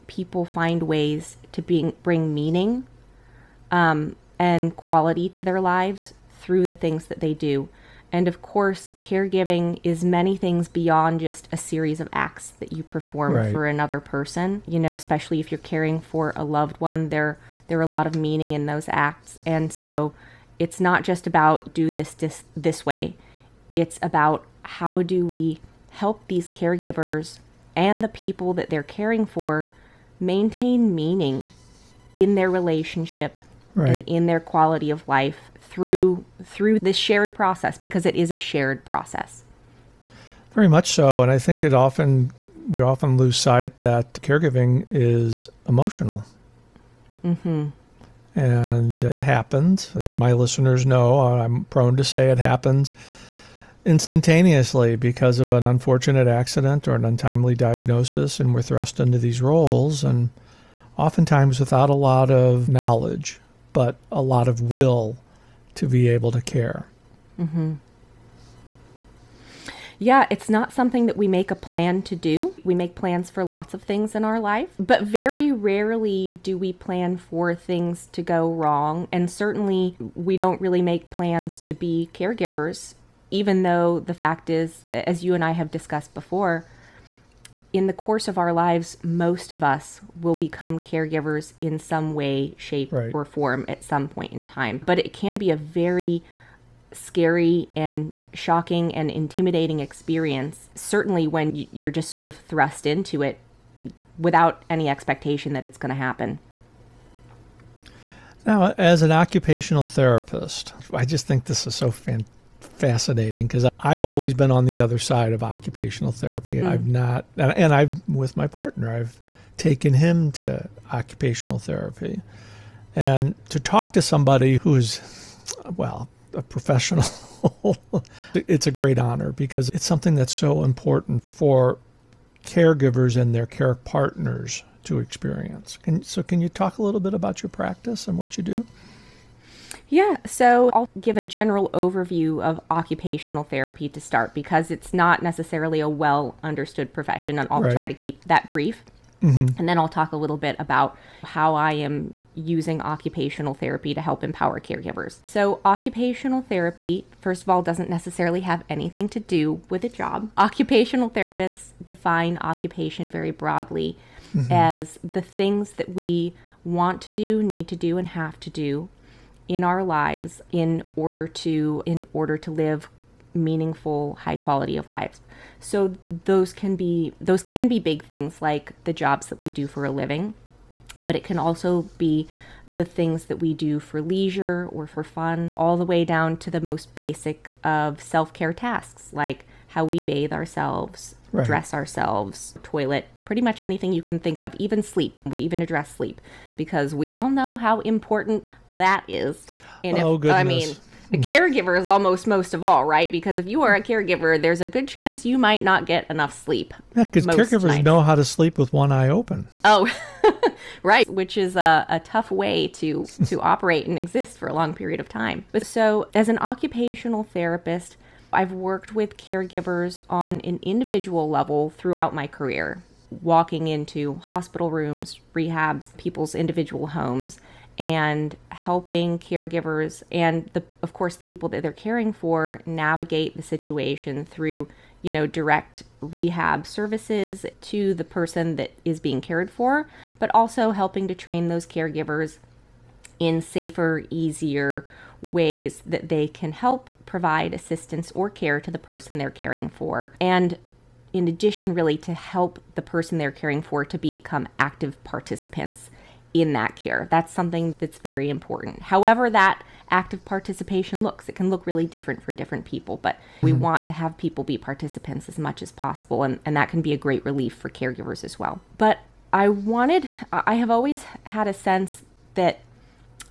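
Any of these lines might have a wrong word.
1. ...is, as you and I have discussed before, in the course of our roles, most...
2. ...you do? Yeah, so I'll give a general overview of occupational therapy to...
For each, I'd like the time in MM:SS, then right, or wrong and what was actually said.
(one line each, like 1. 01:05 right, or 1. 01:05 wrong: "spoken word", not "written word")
1. 01:24 wrong: "lives", not "roles"
2. 02:18 right.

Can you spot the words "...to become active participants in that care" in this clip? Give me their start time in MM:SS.
04:13.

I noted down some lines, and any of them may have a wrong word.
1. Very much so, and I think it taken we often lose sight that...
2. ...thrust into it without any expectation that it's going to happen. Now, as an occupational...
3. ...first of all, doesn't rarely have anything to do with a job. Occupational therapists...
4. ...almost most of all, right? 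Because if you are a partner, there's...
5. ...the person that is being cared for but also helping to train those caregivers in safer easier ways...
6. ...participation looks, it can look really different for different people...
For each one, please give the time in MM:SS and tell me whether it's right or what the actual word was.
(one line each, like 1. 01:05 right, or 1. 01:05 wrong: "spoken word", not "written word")
1. 00:40 wrong: "often", not "taken"
2. 01:42 right
3. 02:37 wrong: "necessarily", not "rarely"
4. 03:21 wrong: "caregiver", not "partner"
5. 03:57 right
6. 04:20 right.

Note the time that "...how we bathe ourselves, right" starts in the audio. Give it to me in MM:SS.
03:09.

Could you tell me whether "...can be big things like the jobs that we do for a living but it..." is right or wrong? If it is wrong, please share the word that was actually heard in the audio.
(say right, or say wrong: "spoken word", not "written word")
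right.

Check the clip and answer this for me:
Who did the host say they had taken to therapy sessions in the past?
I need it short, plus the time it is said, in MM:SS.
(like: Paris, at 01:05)
partner, at 01:58.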